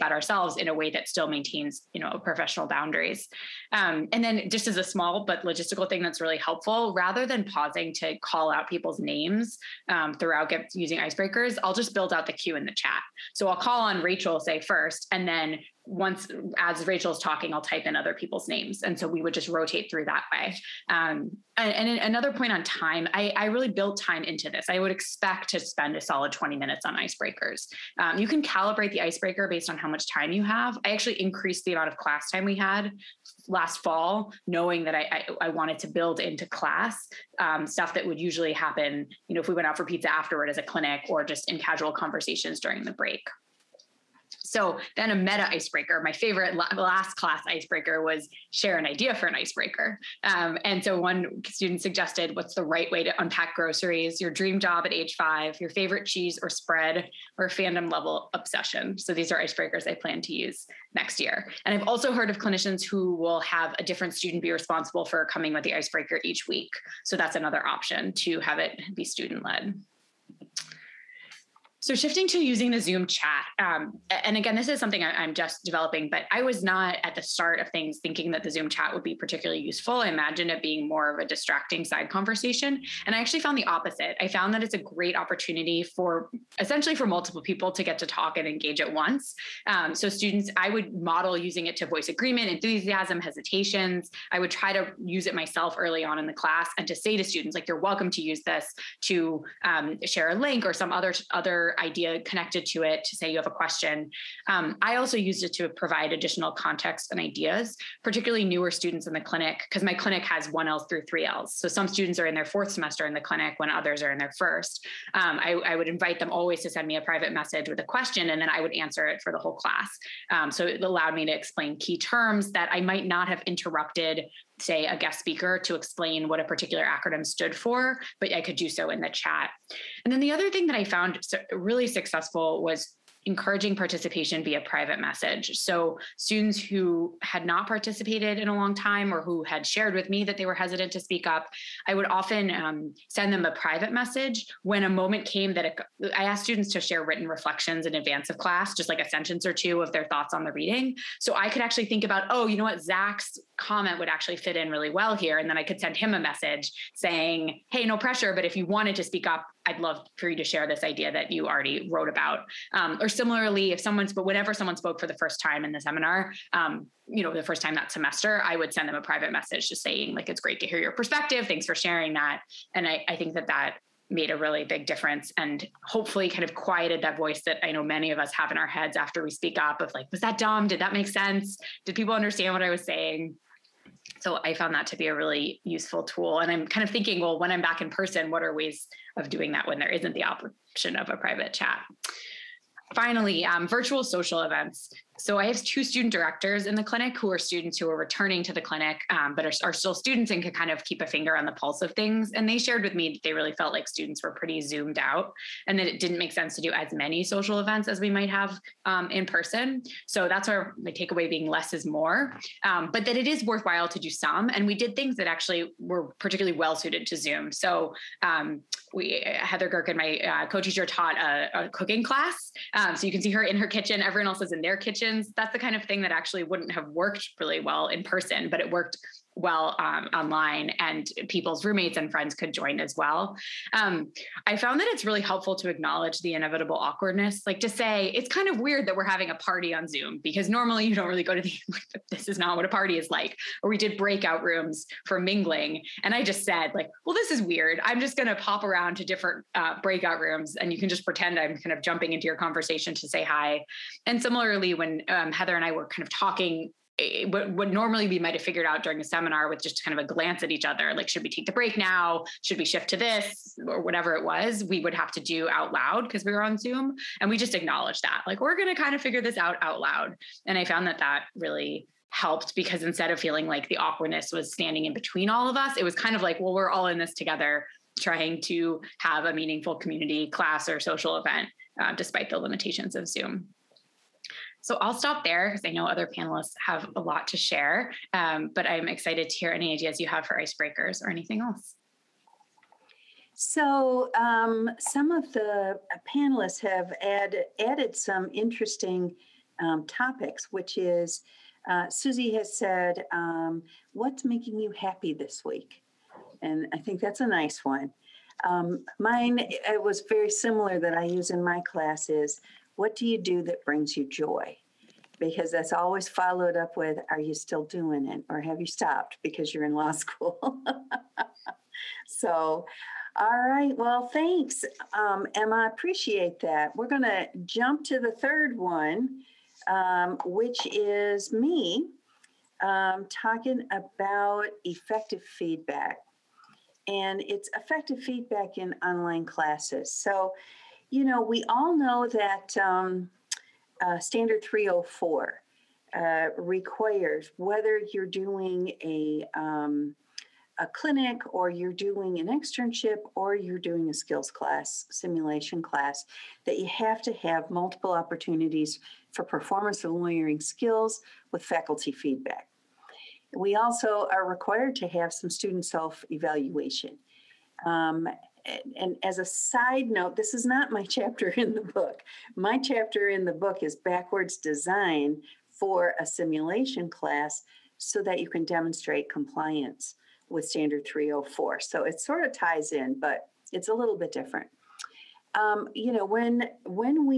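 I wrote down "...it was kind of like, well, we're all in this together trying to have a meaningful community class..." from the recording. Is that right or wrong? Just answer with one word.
right.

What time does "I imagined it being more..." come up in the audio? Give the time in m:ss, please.
1:20.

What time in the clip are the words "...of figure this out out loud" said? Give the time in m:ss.
4:28.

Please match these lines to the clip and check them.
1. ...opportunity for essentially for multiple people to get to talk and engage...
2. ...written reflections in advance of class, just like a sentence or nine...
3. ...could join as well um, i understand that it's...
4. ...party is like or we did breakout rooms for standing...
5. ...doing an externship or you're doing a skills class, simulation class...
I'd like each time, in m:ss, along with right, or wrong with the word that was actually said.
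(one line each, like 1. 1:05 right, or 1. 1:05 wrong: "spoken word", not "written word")
1. 1:25 right
2. 2:27 wrong: "two", not "nine"
3. 3:52 wrong: "found", not "understand"
4. 4:02 wrong: "mingling", not "standing"
5. 5:51 right.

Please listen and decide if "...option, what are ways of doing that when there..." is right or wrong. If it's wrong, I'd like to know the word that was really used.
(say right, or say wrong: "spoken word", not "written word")
wrong: "person", not "option".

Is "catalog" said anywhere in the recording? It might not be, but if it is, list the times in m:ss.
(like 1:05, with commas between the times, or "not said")
not said.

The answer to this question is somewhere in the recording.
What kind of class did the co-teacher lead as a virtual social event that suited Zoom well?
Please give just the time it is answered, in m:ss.
3:41.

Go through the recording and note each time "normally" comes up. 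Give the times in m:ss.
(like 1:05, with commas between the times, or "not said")
4:00, 4:17.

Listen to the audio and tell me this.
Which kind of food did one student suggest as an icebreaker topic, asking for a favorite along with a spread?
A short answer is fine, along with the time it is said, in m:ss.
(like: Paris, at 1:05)
cheese, at 0:56.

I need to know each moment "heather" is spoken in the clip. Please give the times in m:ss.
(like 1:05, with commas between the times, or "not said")
3:39, 4:15.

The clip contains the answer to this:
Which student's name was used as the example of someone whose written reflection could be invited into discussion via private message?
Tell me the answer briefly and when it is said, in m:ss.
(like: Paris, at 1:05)
Zach, at 2:32.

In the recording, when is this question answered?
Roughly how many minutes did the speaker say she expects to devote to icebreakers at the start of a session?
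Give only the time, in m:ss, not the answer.
0:26.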